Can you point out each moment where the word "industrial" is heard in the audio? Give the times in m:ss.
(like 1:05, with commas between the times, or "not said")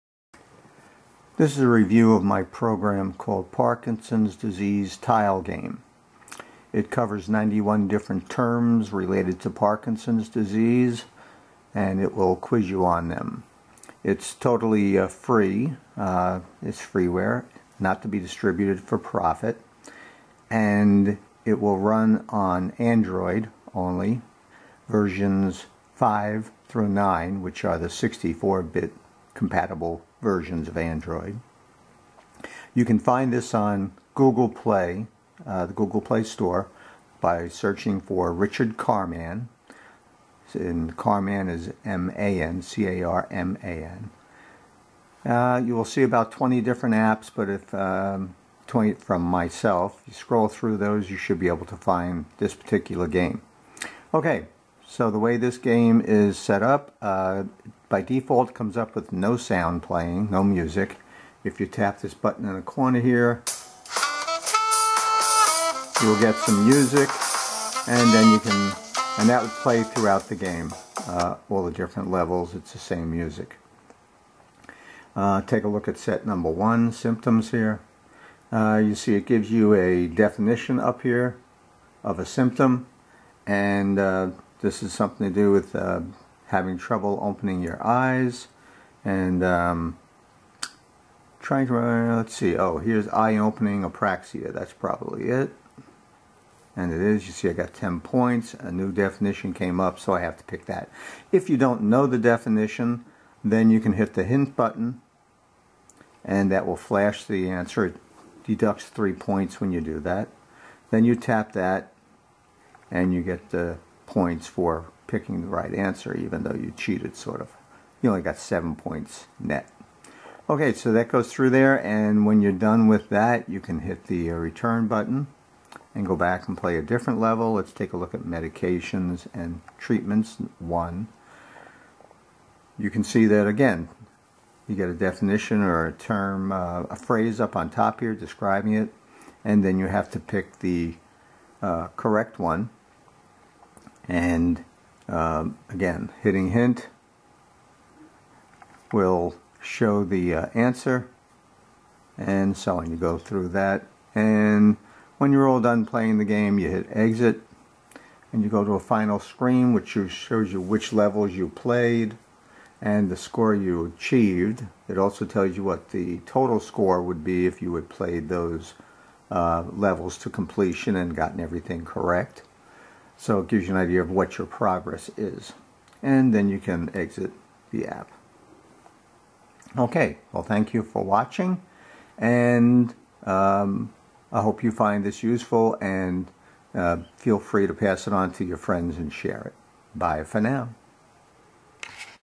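not said.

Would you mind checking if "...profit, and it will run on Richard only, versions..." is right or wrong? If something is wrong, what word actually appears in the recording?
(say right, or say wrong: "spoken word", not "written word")
wrong: "Android", not "Richard".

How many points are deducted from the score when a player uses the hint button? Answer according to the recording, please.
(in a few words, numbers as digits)
3.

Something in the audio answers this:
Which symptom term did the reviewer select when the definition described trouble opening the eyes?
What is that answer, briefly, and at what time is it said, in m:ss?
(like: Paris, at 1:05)
eye opening apraxia, at 1:33.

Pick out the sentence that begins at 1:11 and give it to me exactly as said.
Uh, all the different levels, it's the same music.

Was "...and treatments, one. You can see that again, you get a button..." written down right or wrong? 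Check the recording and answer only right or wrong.
wrong.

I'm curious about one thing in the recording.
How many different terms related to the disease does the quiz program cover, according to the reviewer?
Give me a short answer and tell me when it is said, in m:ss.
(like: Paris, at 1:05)
91, at 0:07.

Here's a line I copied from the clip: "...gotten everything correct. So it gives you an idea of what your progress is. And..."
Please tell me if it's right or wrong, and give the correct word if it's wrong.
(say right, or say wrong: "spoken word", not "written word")
right.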